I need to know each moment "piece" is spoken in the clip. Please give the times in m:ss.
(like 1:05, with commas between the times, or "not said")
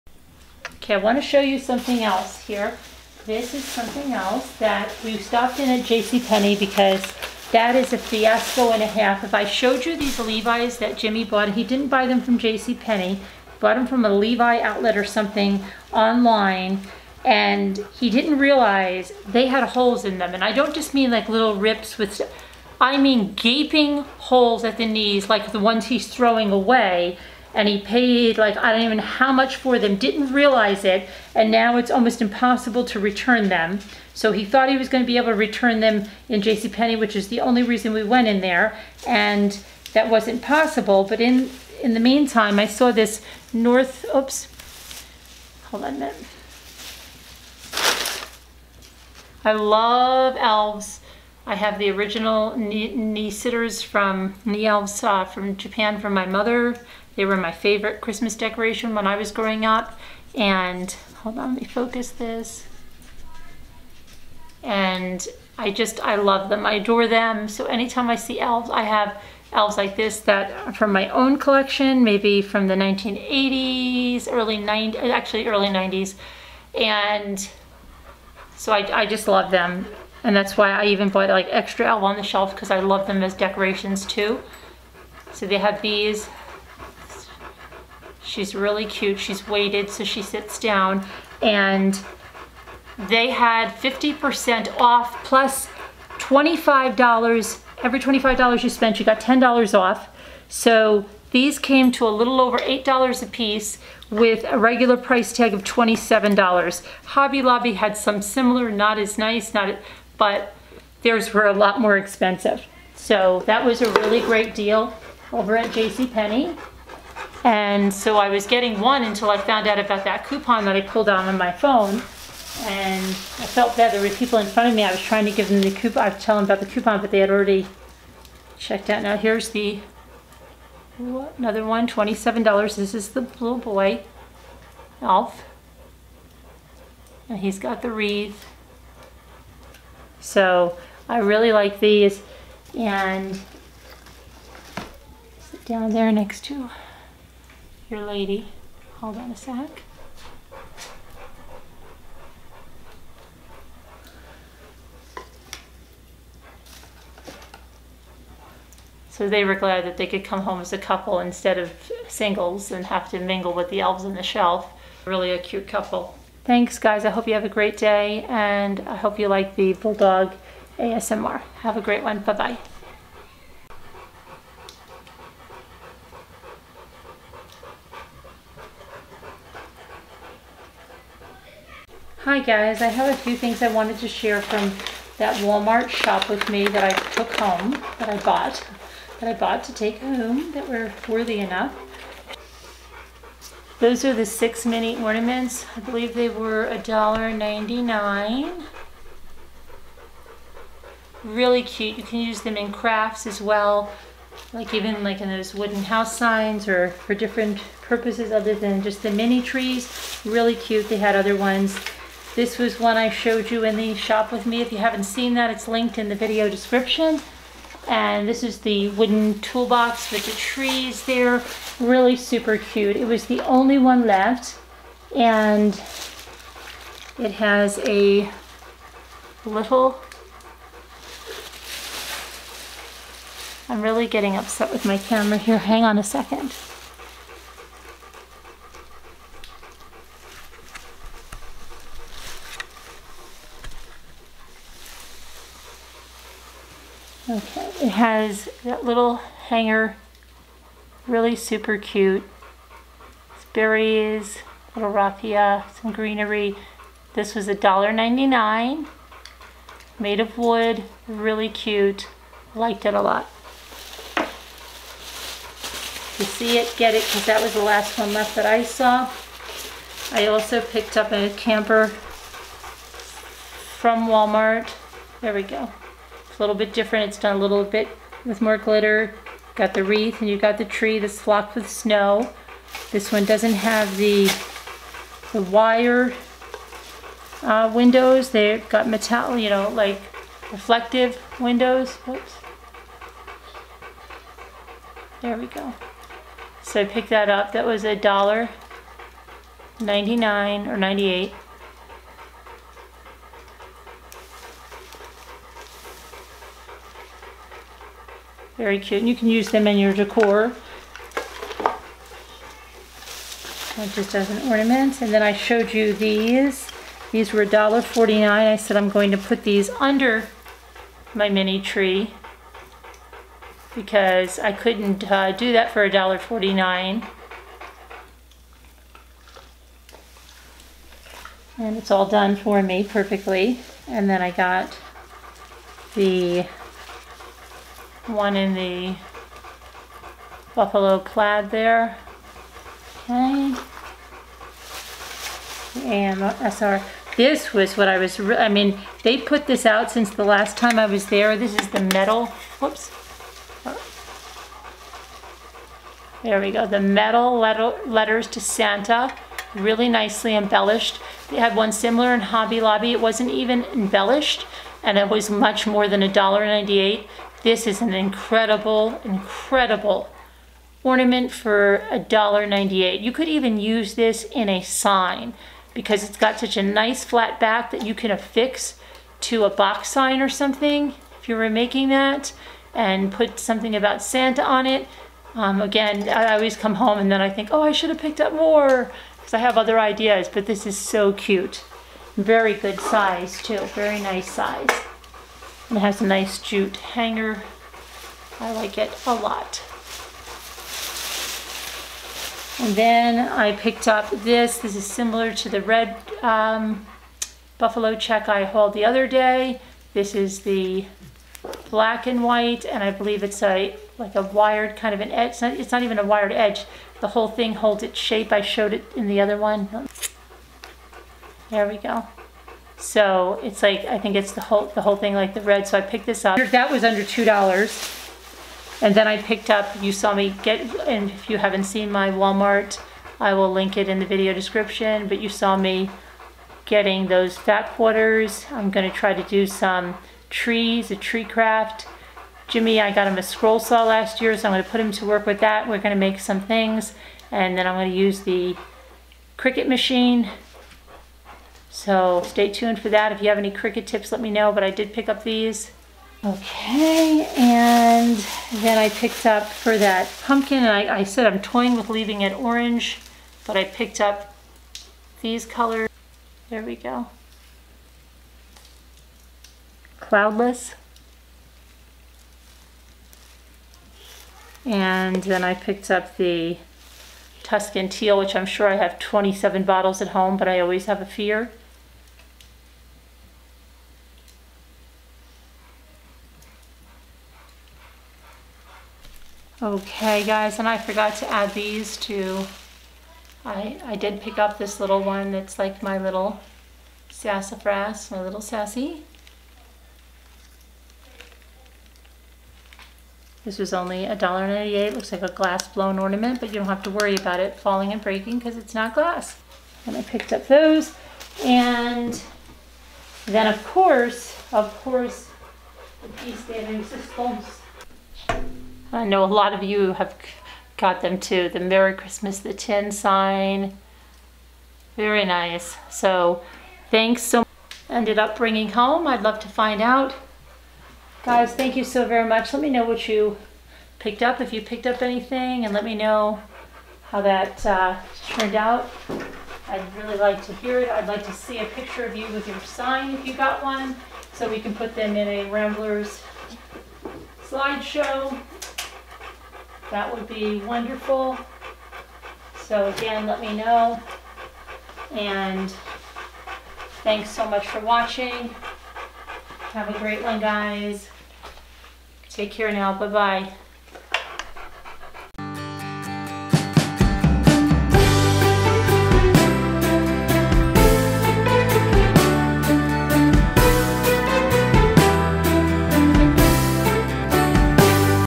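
1:43, 8:36.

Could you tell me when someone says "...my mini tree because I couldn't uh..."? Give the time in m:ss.
5:21.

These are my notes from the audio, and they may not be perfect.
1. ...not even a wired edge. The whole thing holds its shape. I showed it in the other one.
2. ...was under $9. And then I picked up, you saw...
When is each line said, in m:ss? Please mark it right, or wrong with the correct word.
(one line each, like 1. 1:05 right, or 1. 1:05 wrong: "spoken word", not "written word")
1. 6:55 right
2. 7:06 wrong: "2", not "9".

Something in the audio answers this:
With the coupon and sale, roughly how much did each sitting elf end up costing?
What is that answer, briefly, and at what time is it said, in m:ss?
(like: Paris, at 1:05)
a little over $8, at 1:42.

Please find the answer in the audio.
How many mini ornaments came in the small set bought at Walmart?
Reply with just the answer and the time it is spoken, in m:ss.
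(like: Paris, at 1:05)
6, at 3:14.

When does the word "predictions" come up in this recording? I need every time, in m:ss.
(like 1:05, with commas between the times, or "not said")
not said.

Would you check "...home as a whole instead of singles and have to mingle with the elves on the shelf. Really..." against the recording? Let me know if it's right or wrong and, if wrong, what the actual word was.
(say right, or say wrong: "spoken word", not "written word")
wrong: "couple", not "whole".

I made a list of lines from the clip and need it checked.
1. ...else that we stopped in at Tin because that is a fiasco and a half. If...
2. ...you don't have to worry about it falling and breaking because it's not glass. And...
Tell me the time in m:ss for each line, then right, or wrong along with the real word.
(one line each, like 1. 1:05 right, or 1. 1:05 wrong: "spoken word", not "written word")
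1. 0:04 wrong: "JCPenney", not "Tin"
2. 8:26 right.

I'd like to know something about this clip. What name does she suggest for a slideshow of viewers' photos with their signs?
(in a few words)
Ramblers slideshow.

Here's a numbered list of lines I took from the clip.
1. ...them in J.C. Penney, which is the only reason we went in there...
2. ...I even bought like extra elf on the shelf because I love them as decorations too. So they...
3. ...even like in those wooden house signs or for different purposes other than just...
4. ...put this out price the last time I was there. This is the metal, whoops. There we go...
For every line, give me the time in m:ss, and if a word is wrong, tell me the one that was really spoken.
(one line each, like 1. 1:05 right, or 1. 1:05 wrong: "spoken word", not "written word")
1. 0:35 right
2. 1:20 right
3. 3:24 right
4. 5:49 wrong: "since", not "price".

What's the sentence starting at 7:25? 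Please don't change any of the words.
We're gonna make some things, and then I'm gonna use the Cricut machine so stay tuned for that.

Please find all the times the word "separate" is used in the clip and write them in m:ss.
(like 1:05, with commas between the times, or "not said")
not said.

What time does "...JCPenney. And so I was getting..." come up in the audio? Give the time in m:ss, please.
1:55.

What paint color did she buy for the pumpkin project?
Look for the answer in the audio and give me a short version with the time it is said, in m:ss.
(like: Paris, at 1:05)
Tuscan teal, at 7:57.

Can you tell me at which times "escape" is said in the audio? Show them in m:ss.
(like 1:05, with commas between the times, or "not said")
not said.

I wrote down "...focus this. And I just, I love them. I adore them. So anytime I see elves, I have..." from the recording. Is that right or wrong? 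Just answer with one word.
right.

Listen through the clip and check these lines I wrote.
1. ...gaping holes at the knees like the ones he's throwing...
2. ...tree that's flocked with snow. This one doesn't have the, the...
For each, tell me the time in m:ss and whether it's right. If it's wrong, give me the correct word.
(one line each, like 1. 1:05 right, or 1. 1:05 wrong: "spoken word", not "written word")
1. 0:23 right
2. 4:40 right.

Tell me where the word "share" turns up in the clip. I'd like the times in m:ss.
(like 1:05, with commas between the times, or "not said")
3:04.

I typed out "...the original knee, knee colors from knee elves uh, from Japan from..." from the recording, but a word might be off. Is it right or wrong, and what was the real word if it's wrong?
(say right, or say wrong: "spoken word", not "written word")
wrong: "sitters", not "colors".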